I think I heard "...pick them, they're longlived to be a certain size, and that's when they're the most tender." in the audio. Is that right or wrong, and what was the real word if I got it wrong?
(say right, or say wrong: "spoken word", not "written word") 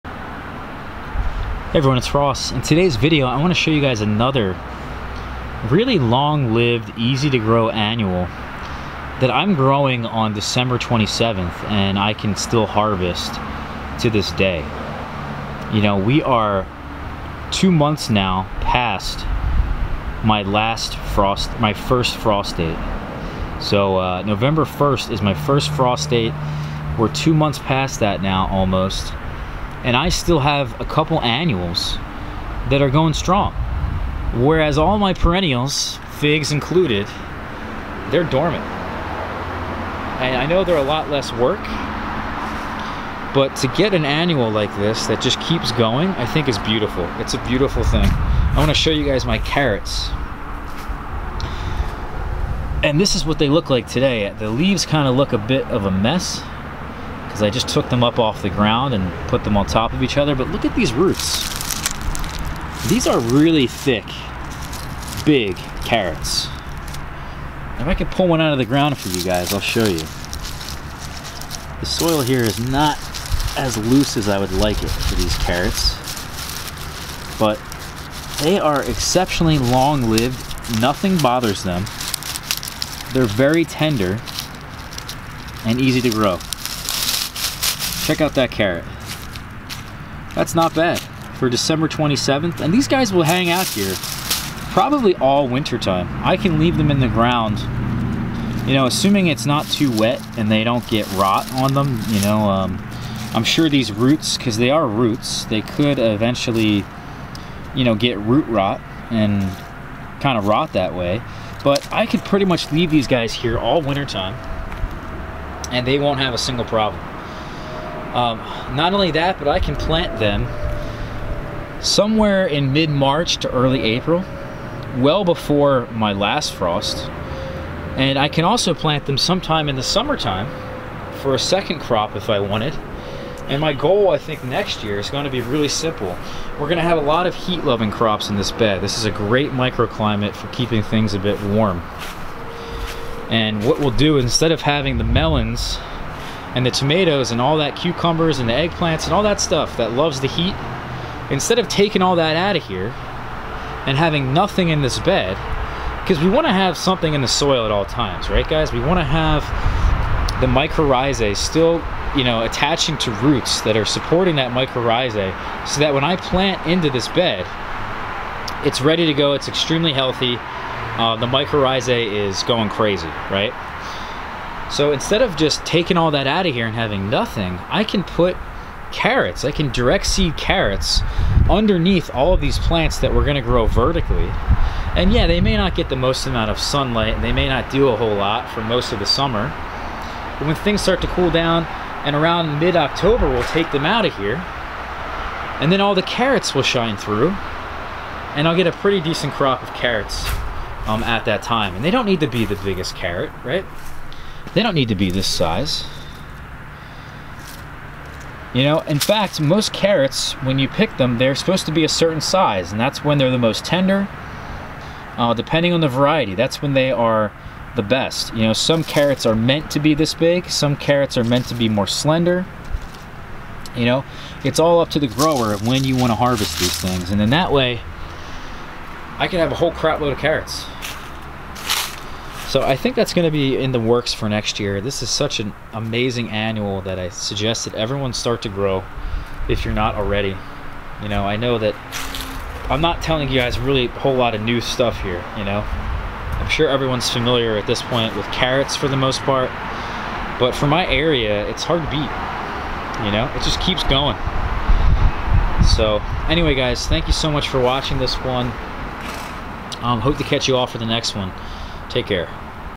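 wrong: "supposed", not "longlived".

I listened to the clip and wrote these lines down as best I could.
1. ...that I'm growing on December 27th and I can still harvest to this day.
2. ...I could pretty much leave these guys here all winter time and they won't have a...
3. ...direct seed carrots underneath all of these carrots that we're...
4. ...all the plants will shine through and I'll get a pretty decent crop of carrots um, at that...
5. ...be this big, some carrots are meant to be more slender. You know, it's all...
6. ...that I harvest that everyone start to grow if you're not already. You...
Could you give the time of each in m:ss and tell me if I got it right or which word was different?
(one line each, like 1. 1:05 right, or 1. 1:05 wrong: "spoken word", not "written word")
1. 0:09 right
2. 1:51 right
3. 2:59 wrong: "plants", not "carrots"
4. 3:15 wrong: "carrots", not "plants"
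5. 3:39 right
6. 3:56 wrong: "suggest", not "harvest".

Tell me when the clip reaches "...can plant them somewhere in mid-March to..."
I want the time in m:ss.
1:59.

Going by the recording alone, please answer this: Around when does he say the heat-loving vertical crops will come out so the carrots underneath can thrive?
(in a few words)
mid-October.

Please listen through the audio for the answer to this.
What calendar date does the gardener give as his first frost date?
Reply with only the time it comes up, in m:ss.
0:24.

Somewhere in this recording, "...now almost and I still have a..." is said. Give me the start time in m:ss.
0:28.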